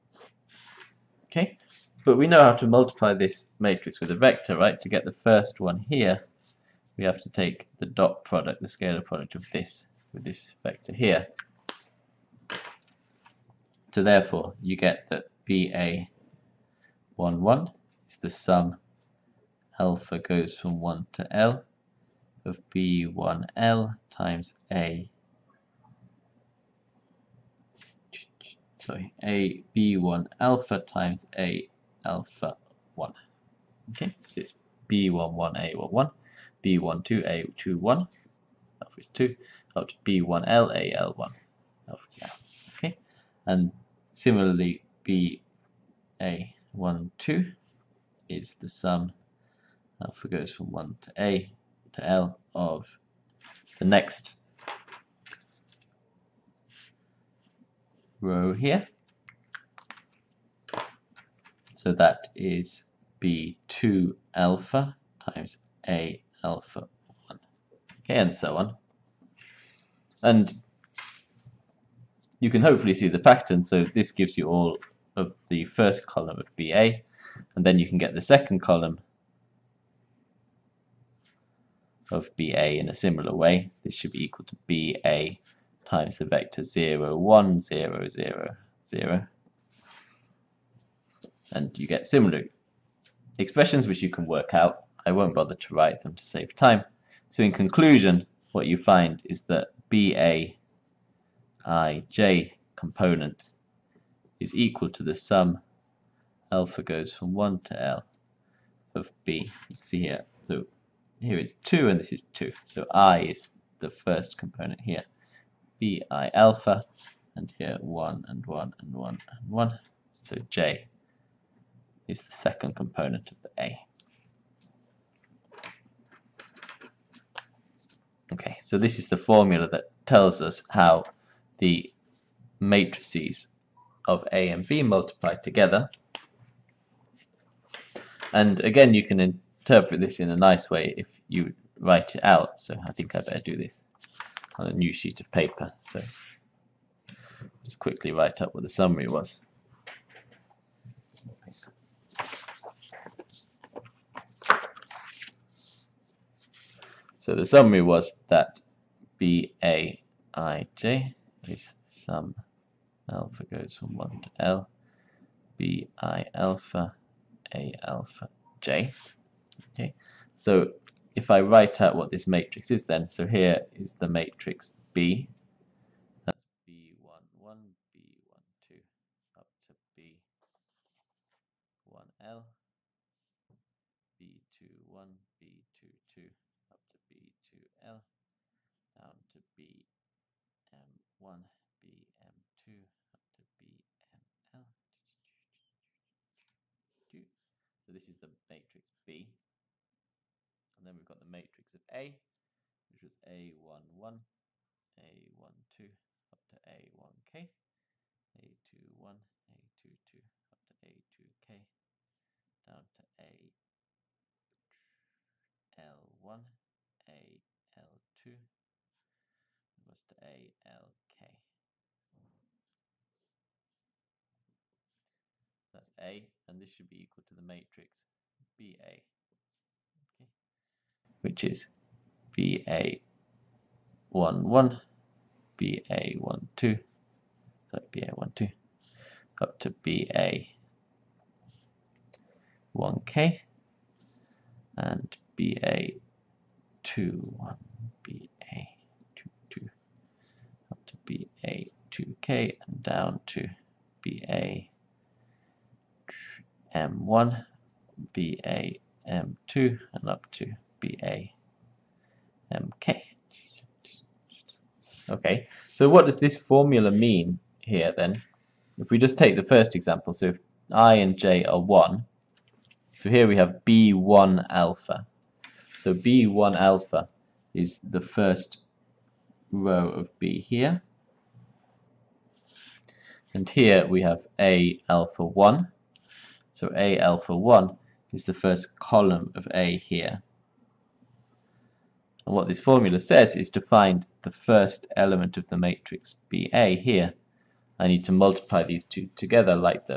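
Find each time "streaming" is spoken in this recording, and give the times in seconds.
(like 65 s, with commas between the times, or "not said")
not said.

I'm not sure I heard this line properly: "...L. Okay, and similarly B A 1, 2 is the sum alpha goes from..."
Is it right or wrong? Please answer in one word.
right.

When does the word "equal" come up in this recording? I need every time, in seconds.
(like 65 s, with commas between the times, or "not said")
84 s, 104 s, 227 s.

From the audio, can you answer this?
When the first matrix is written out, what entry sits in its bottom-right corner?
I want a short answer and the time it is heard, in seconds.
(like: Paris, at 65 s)
BML, at 193 s.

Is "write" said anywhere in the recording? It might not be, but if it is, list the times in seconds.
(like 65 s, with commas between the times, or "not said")
95 s, 141 s, 148 s, 171 s.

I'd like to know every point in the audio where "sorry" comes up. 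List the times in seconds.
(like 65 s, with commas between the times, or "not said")
28 s, 236 s.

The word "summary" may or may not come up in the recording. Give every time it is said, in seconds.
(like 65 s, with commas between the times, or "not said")
148 s, 157 s.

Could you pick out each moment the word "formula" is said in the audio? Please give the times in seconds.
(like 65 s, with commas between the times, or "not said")
129 s, 266 s, 292 s.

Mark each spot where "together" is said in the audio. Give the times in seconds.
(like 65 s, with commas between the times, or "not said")
135 s, 299 s.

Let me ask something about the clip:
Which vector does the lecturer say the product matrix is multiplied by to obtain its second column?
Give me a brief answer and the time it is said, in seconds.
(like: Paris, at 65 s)
0, 1, 0, 0, 0, at 86 s.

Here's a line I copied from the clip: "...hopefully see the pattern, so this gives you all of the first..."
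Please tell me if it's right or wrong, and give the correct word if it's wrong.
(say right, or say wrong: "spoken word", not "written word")
right.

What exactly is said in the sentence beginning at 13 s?
So therefore, you get that BA 1, 1 is the sum alpha goes from 1 to L of B1L times A.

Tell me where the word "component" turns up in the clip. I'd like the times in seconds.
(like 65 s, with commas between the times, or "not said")
102 s, 114 s, 122 s.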